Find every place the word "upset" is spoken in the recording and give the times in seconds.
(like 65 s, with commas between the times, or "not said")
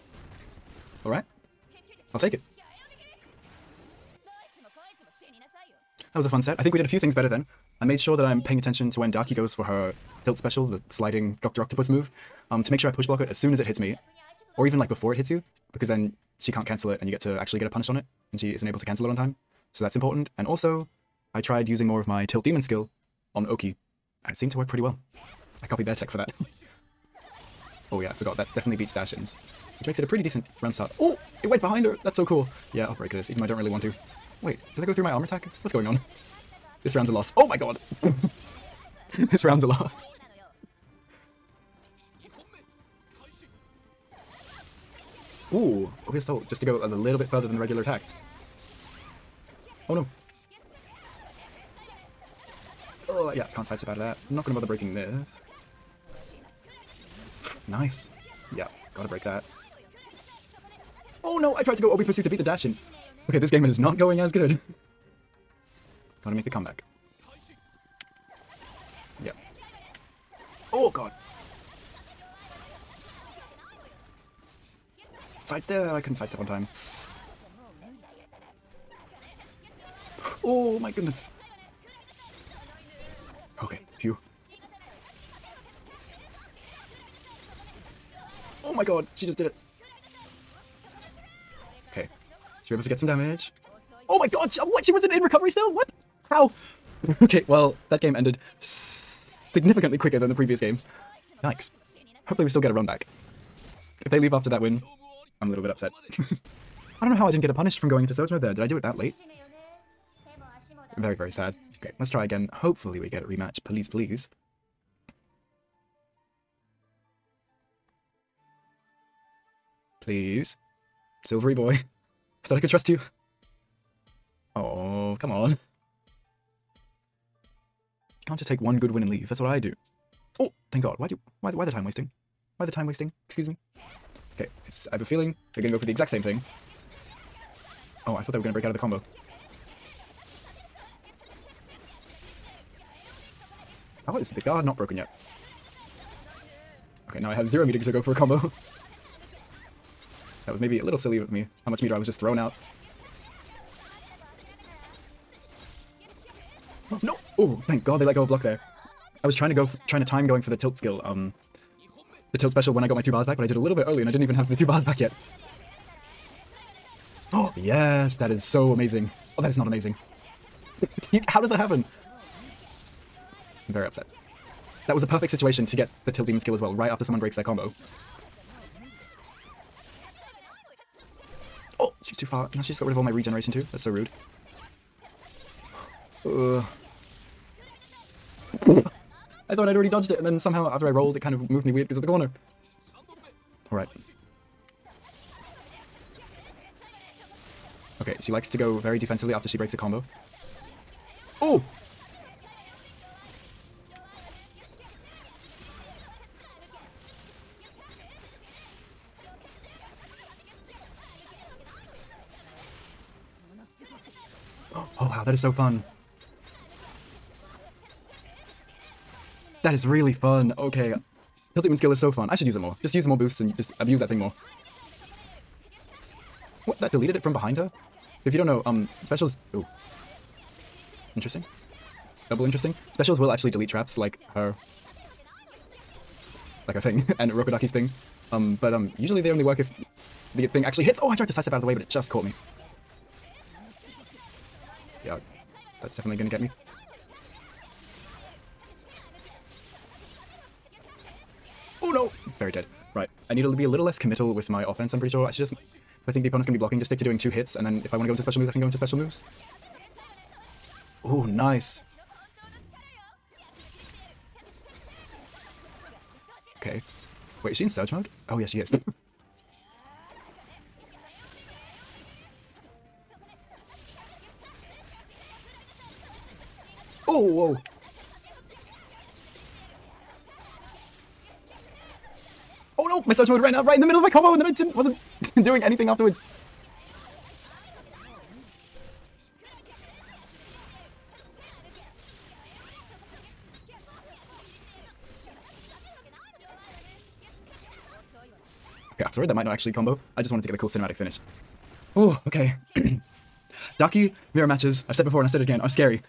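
105 s, 173 s.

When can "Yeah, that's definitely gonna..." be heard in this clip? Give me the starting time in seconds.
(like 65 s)
245 s.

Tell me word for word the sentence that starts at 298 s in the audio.
Okay, I'm sorry that might not actually combo.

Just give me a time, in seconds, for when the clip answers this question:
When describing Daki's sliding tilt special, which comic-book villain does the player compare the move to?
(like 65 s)
11 s.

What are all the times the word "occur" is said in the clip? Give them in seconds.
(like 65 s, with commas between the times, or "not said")
not said.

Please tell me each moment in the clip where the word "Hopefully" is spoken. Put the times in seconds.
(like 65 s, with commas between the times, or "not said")
102 s, 112 s.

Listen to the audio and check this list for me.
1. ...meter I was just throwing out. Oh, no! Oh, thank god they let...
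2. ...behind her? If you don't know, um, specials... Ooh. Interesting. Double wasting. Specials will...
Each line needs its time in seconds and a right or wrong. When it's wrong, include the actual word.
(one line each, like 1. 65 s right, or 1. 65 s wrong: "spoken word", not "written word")
1. 151 s right
2. 227 s wrong: "interesting", not "wasting".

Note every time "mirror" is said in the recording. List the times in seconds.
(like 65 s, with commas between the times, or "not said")
304 s.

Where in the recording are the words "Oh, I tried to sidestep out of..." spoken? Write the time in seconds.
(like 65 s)
241 s.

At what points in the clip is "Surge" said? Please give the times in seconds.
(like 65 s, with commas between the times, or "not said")
108 s, 267 s, 283 s.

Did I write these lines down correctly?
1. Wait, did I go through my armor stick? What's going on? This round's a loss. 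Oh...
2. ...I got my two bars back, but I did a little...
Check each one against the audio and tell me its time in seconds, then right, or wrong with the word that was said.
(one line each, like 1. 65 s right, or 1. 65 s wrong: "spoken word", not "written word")
1. 34 s wrong: "attack", not "stick"
2. 162 s right.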